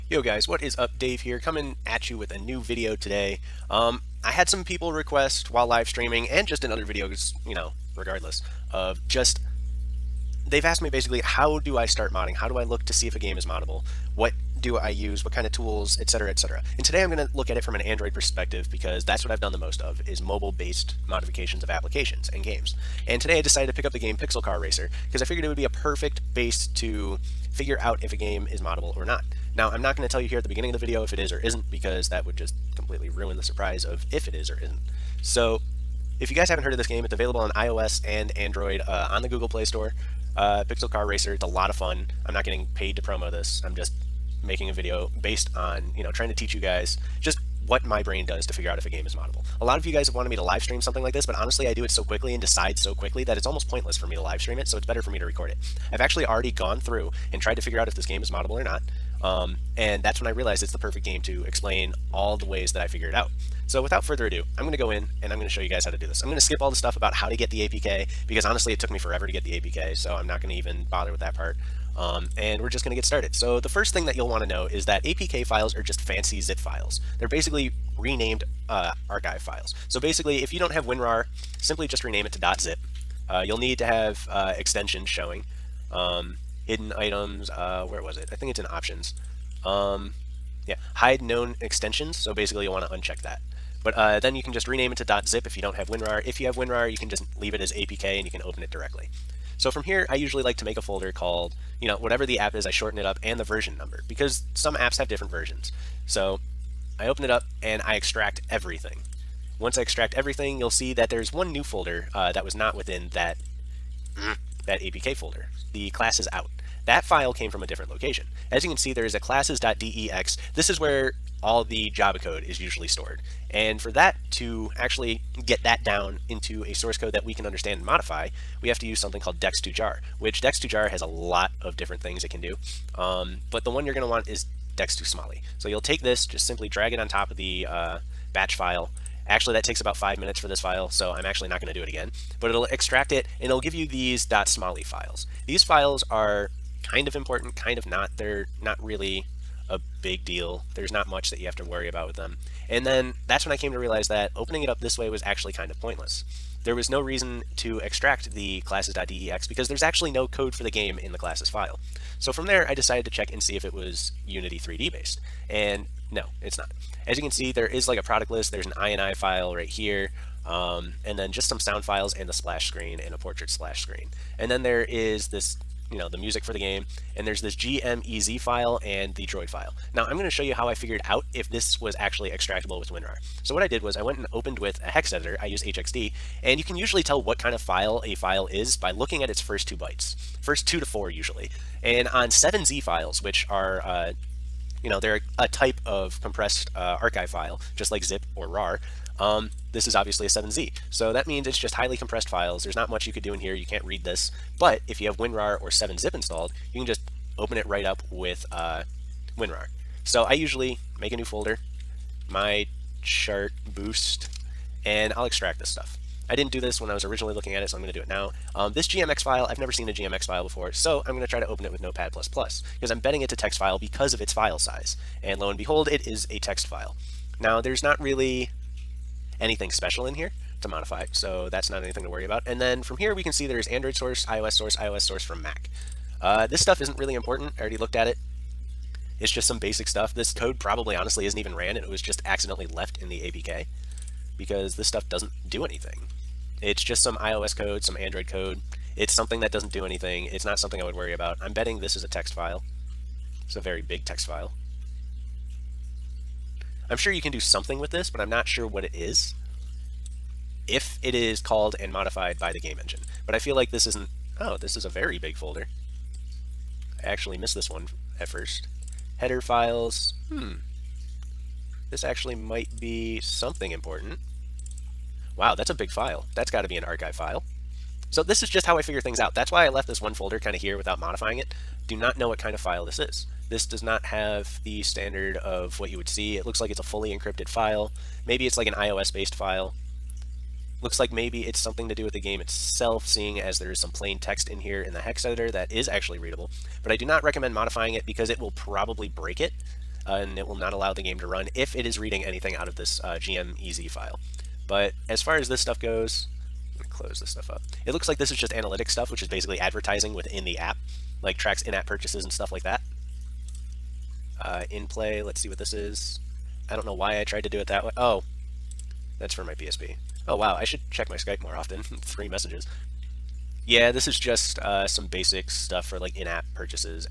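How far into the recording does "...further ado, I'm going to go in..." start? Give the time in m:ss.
1:04.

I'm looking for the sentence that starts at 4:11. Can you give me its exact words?
I'm betting this is a text file.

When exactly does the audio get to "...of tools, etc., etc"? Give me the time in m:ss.
0:15.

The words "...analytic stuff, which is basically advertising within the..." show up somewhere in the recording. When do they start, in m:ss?
5:08.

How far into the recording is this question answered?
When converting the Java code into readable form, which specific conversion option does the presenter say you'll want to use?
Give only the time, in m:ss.
2:14.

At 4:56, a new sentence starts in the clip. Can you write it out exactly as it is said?
But I do not recommend modifying it because it will probably break it.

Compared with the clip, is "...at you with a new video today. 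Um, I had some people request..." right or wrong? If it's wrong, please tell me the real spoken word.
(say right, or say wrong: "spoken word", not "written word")
right.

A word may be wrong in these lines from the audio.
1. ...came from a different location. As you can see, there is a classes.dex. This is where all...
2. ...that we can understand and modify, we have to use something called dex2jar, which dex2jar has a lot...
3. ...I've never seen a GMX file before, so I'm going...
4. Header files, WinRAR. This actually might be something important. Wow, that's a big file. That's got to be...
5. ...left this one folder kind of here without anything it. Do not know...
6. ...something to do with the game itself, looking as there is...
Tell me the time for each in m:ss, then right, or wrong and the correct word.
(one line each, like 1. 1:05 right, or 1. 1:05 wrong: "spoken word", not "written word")
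1. 1:57 right
2. 2:07 right
3. 3:39 right
4. 4:29 wrong: "Hmm", not "WinRAR"
5. 4:39 wrong: "modifying", not "anything"
6. 4:51 wrong: "seeing", not "looking".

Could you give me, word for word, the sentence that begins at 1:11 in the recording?
Um, and we're just going to get started.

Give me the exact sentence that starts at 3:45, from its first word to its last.
And lo and behold, it is a text file.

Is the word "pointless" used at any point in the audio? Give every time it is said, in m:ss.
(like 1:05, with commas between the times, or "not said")
0:53, 2:35.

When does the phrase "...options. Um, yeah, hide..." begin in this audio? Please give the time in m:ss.
1:28.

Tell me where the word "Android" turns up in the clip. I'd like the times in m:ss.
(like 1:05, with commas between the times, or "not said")
0:17, 0:38, 3:53, 4:07.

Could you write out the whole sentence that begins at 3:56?
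Uh, this stuff isn't really important.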